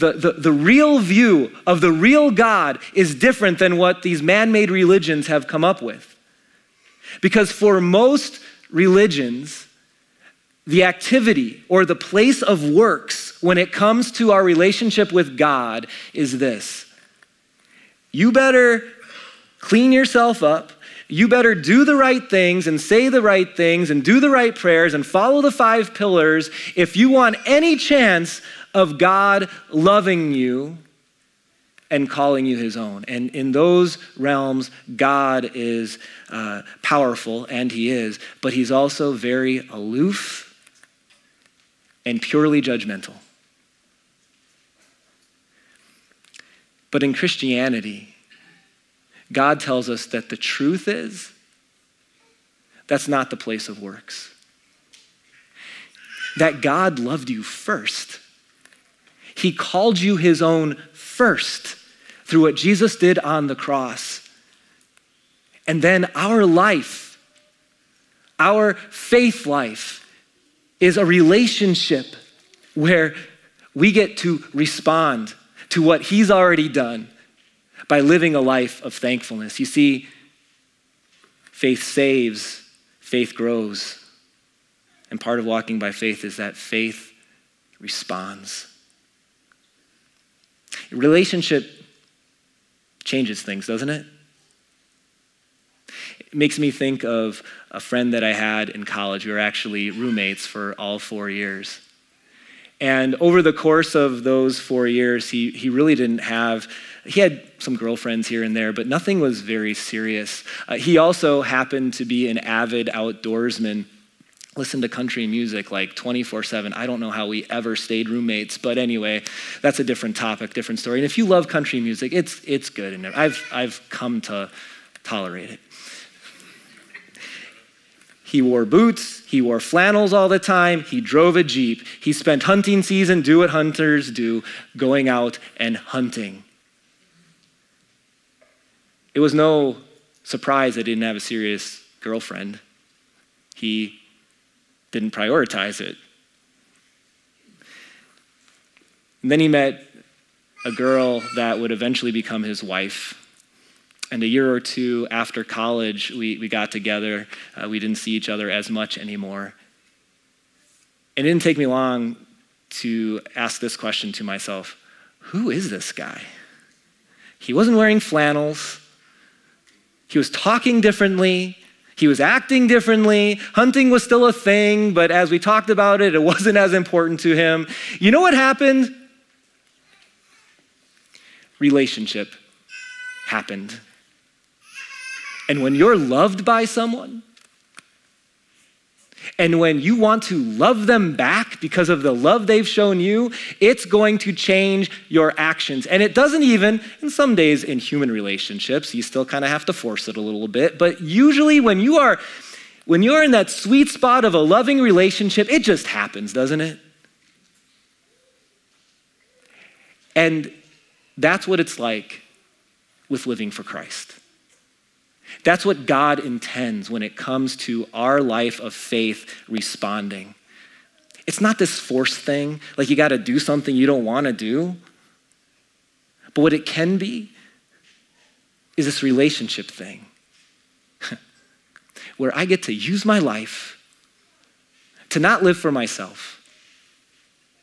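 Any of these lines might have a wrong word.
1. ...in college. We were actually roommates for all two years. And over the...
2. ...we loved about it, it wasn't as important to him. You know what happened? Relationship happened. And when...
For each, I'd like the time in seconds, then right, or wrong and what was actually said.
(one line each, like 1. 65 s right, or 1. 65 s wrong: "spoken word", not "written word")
1. 98 s wrong: "four", not "two"
2. 175 s wrong: "talked", not "loved".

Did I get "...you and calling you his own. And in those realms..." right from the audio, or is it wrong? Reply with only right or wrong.
right.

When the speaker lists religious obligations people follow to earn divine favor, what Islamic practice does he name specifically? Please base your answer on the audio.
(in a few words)
five pillars.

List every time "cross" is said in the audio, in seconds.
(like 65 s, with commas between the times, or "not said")
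63 s.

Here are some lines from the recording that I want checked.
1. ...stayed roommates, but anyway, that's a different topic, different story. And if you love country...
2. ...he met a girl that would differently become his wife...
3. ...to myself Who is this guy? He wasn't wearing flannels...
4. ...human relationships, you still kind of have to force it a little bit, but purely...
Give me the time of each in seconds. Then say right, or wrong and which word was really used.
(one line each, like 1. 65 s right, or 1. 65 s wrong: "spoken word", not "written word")
1. 117 s right
2. 149 s wrong: "eventually", not "differently"
3. 164 s right
4. 197 s wrong: "usually", not "purely".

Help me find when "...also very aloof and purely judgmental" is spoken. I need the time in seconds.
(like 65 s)
38 s.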